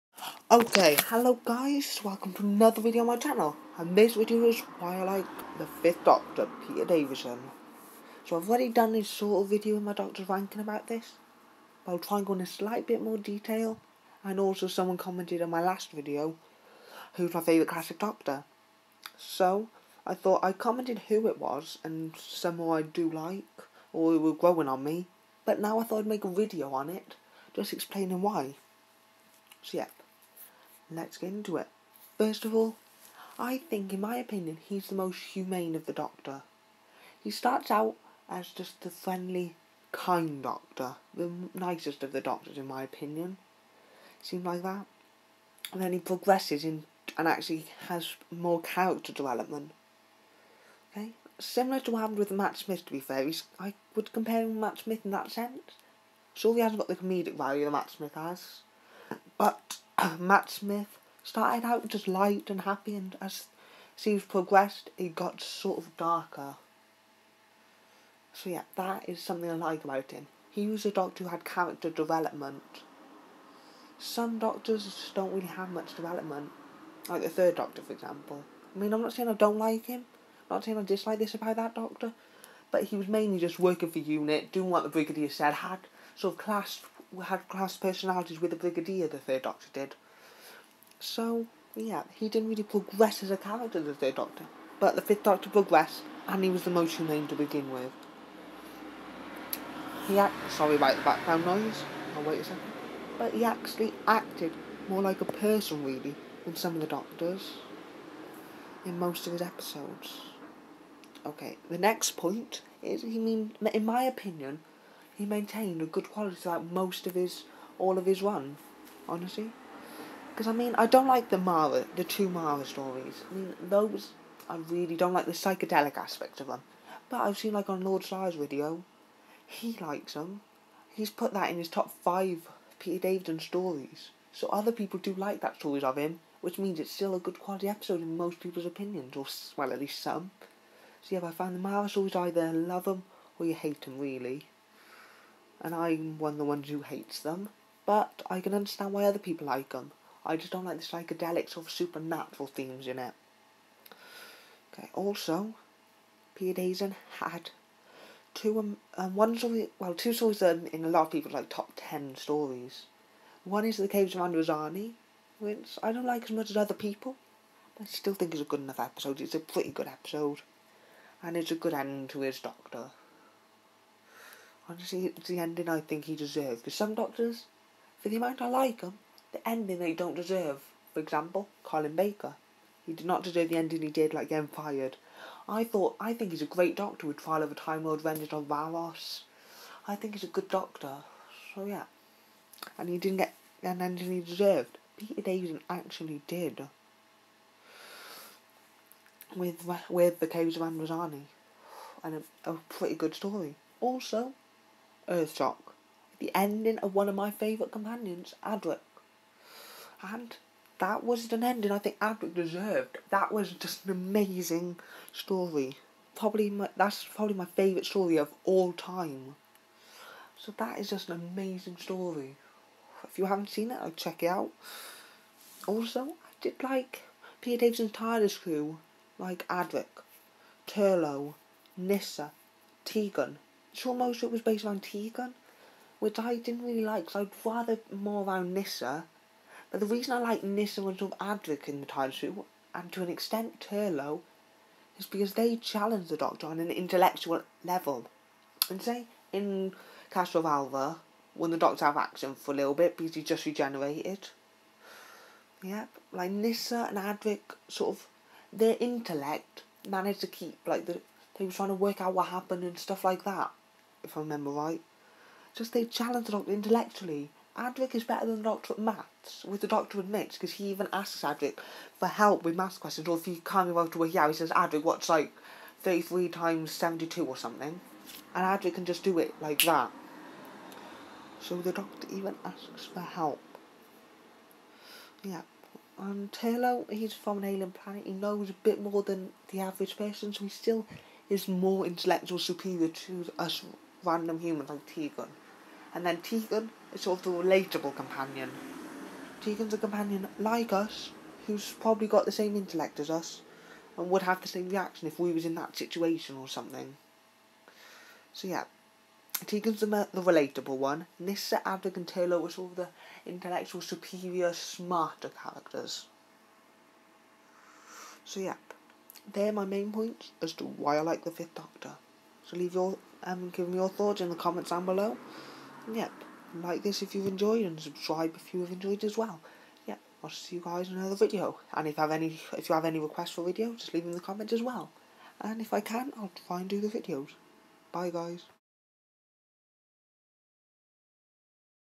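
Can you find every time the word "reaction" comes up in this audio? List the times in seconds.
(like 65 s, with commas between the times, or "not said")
304 s.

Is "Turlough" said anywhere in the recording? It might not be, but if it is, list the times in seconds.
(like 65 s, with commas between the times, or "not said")
230 s, 243 s.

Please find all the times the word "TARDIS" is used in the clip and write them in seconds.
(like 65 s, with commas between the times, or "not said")
227 s.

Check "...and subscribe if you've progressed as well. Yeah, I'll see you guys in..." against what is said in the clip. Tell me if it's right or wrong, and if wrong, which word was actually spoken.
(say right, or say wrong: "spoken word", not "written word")
wrong: "enjoyed", not "progressed".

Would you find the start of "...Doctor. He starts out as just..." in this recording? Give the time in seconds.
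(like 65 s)
35 s.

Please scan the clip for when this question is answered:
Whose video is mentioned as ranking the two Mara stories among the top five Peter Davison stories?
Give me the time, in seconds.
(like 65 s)
127 s.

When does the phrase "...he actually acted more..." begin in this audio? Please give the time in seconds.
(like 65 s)
103 s.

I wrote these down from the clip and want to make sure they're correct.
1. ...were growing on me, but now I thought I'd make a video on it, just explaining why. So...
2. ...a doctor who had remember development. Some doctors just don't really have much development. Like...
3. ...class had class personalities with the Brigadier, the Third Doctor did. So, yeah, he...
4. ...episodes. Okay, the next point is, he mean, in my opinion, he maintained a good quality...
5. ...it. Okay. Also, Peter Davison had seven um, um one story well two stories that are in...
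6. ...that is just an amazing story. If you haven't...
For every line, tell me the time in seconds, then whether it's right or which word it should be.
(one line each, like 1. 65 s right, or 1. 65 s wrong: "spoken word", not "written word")
1. 24 s right
2. 70 s wrong: "character", not "remember"
3. 86 s right
4. 109 s right
5. 152 s wrong: "two", not "seven"
6. 220 s right.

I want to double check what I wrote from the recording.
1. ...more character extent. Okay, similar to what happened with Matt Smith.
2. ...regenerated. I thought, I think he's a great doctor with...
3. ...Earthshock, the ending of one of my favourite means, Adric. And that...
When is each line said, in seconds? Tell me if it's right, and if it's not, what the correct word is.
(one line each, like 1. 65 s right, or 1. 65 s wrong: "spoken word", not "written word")
1. 48 s wrong: "development", not "extent"
2. 184 s wrong: "fired", not "regenerated"
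3. 205 s wrong: "companions", not "means".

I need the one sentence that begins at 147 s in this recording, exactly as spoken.
But I can understand why other people like them.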